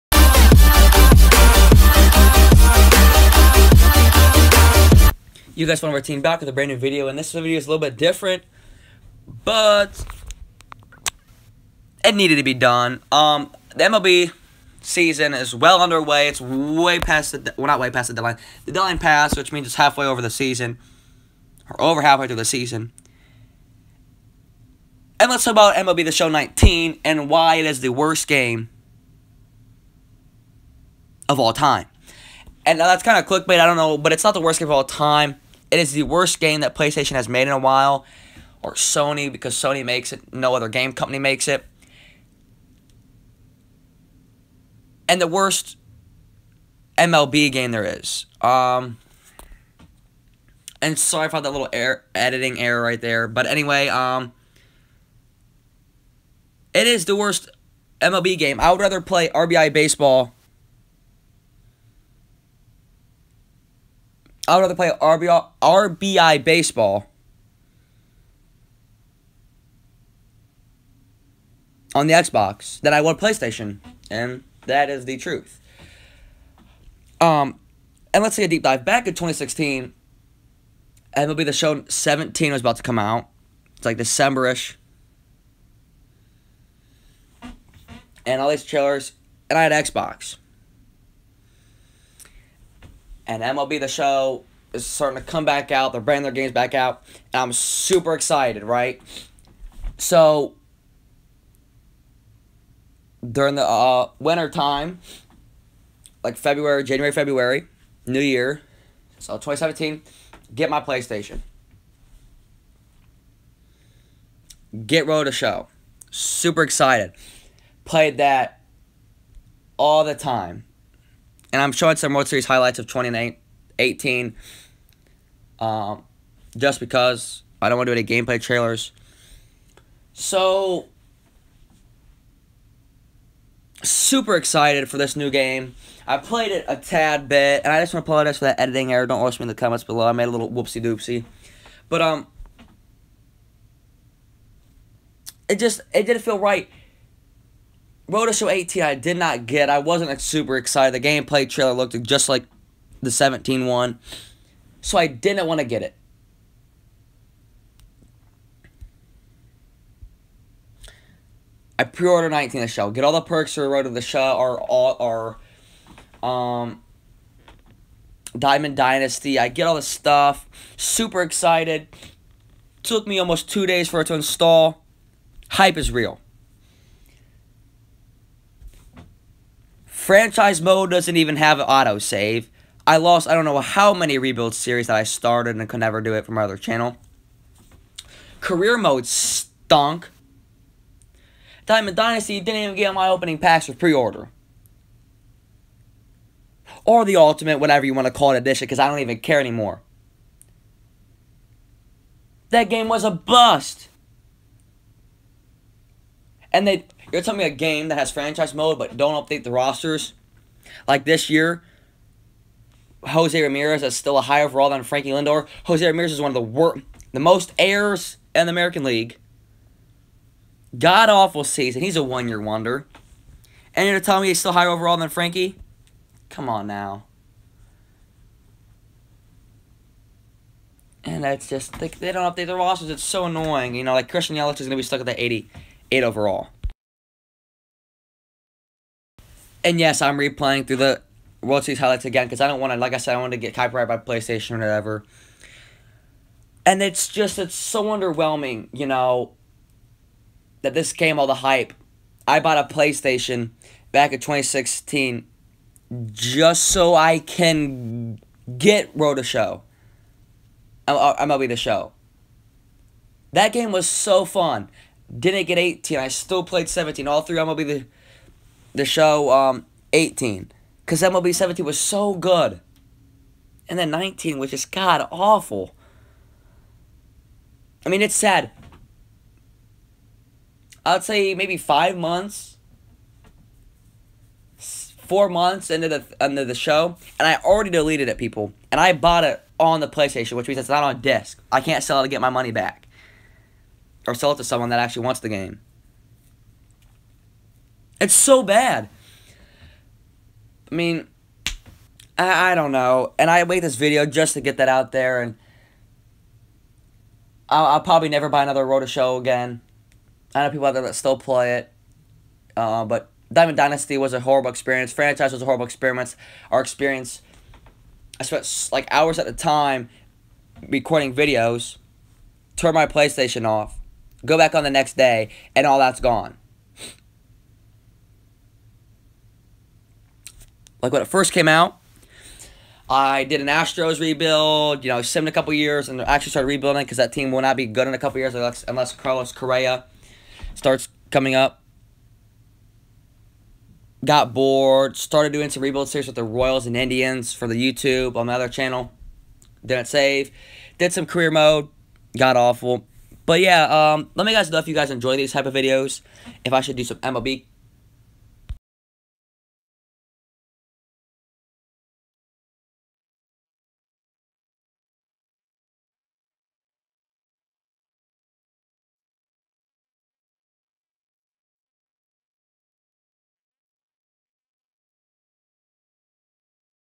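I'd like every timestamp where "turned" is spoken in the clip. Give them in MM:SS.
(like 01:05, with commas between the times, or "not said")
05:22.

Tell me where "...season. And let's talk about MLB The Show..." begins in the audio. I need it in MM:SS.
00:22.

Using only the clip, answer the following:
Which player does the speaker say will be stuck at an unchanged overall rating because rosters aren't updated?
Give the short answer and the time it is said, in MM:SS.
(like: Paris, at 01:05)
Christian Yelich, at 03:54.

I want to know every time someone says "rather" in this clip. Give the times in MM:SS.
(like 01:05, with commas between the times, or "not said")
00:58, 01:04.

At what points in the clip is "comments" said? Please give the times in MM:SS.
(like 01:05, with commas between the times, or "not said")
02:19.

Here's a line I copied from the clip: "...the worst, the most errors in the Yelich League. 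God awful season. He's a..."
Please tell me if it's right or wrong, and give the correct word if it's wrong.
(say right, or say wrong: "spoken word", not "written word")
wrong: "American", not "Yelich".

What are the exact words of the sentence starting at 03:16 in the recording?
Or the ultimate, whatever you want to call it edition, because I don't even care anymore.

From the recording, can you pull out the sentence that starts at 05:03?
And I made this video just to get that out there.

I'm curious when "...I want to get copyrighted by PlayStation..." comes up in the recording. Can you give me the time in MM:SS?
04:03.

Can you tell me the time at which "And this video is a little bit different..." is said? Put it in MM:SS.
00:07.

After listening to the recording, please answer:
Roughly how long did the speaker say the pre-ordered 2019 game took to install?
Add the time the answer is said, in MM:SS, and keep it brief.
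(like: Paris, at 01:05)
Almost two days, at 02:53.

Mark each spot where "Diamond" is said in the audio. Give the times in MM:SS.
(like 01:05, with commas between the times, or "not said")
02:48, 03:11, 05:13.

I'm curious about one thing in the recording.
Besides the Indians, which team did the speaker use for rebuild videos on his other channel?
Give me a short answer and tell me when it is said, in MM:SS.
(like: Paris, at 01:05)
Royals, at 05:46.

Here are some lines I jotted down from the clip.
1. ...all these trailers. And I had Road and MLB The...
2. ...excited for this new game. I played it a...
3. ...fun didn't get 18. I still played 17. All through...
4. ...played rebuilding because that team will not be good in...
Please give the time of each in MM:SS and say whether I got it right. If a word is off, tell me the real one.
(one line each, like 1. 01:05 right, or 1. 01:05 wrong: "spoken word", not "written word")
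1. 01:28 wrong: "Xbox", not "Road"
2. 02:14 right
3. 04:24 right
4. 05:36 wrong: "started", not "played".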